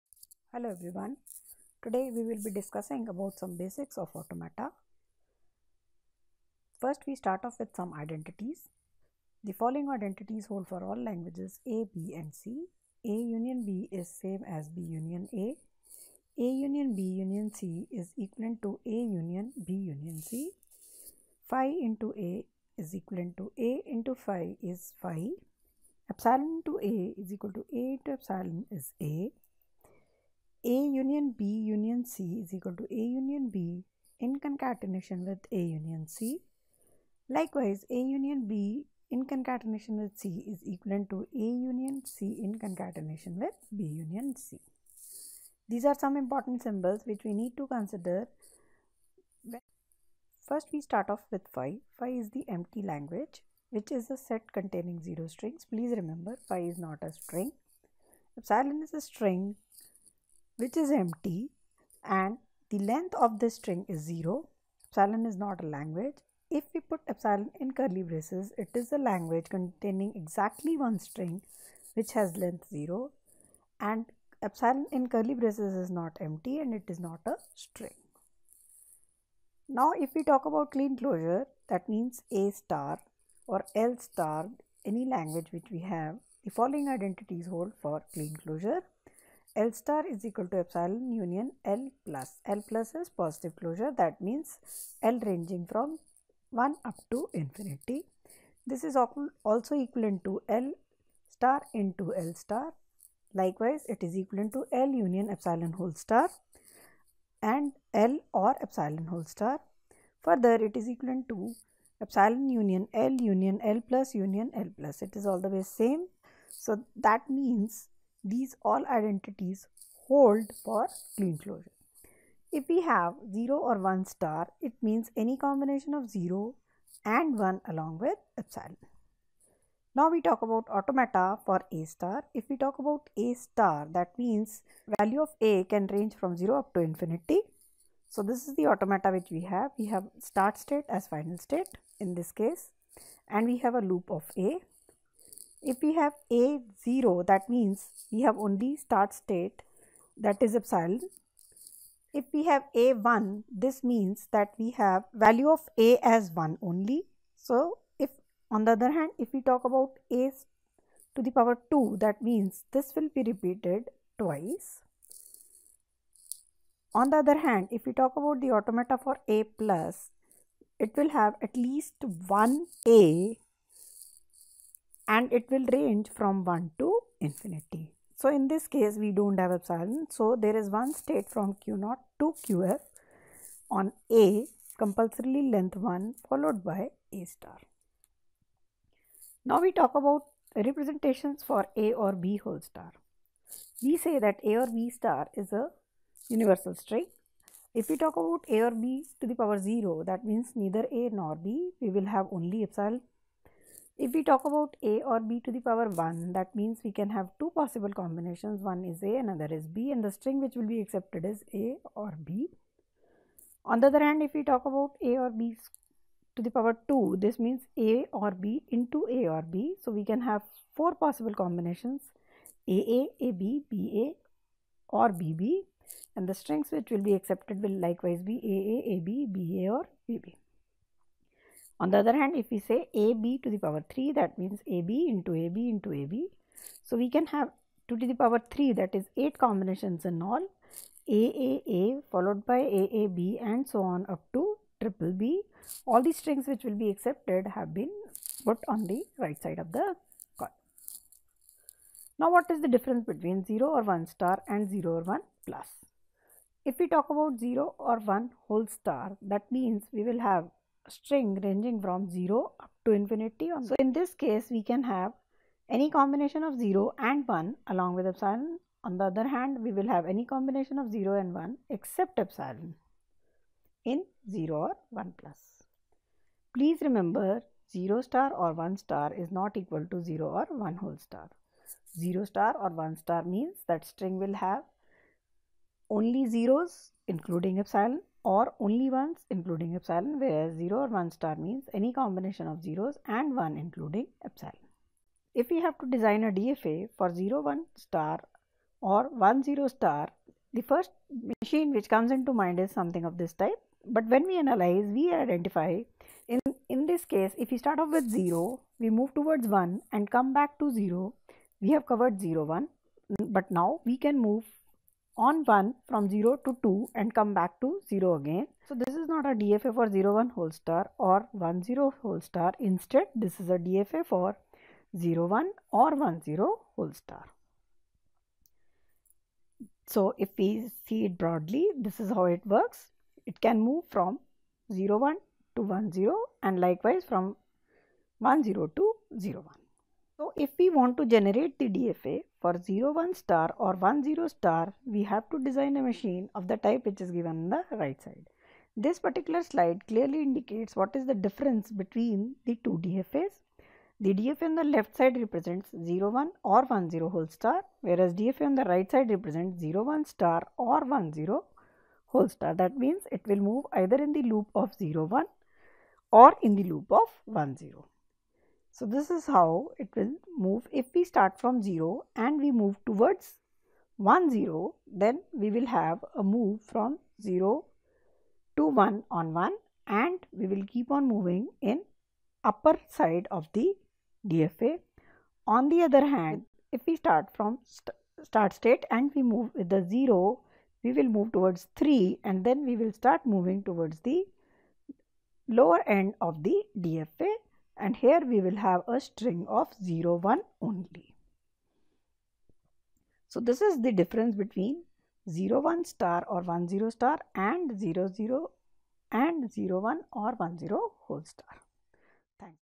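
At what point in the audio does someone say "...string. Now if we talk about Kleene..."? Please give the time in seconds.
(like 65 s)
77 s.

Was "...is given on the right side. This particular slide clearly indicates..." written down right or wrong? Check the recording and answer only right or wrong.
right.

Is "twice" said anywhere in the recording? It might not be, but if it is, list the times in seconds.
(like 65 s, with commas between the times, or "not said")
164 s.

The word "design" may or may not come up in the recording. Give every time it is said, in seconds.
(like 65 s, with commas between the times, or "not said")
295 s, 345 s.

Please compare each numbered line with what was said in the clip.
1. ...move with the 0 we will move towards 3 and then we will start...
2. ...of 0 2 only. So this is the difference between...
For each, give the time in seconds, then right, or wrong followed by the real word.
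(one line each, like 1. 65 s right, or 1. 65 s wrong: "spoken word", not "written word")
1. 389 s right
2. 399 s wrong: "1", not "2".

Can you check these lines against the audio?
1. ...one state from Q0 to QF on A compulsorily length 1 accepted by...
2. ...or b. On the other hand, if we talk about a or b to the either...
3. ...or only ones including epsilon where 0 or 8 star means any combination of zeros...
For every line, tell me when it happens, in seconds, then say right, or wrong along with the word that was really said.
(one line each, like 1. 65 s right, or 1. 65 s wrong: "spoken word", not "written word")
1. 180 s wrong: "followed", not "accepted"
2. 211 s wrong: "power", not "either"
3. 288 s wrong: "1", not "8".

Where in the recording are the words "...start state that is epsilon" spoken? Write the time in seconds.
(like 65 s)
148 s.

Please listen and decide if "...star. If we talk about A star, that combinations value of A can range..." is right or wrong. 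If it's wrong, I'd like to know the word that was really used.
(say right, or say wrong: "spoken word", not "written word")
wrong: "means", not "combinations".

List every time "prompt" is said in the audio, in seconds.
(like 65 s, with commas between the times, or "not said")
not said.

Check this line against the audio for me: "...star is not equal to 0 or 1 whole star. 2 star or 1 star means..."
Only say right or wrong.
wrong.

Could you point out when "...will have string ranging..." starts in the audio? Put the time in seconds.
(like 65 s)
260 s.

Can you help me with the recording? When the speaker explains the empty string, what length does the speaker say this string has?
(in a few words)
0.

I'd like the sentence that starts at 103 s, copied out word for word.
Likewise, it is equivalent to L union epsilon whole star and L or epsilon whole star.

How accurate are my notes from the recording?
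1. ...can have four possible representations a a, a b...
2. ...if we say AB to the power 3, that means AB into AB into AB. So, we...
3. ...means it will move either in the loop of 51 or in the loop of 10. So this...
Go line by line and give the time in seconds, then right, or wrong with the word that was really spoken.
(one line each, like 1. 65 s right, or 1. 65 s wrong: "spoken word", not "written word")
1. 220 s wrong: "combinations", not "representations"
2. 232 s right
3. 362 s wrong: "01", not "51".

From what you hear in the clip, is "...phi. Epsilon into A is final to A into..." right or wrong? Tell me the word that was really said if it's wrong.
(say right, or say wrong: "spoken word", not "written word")
wrong: "equal", not "final".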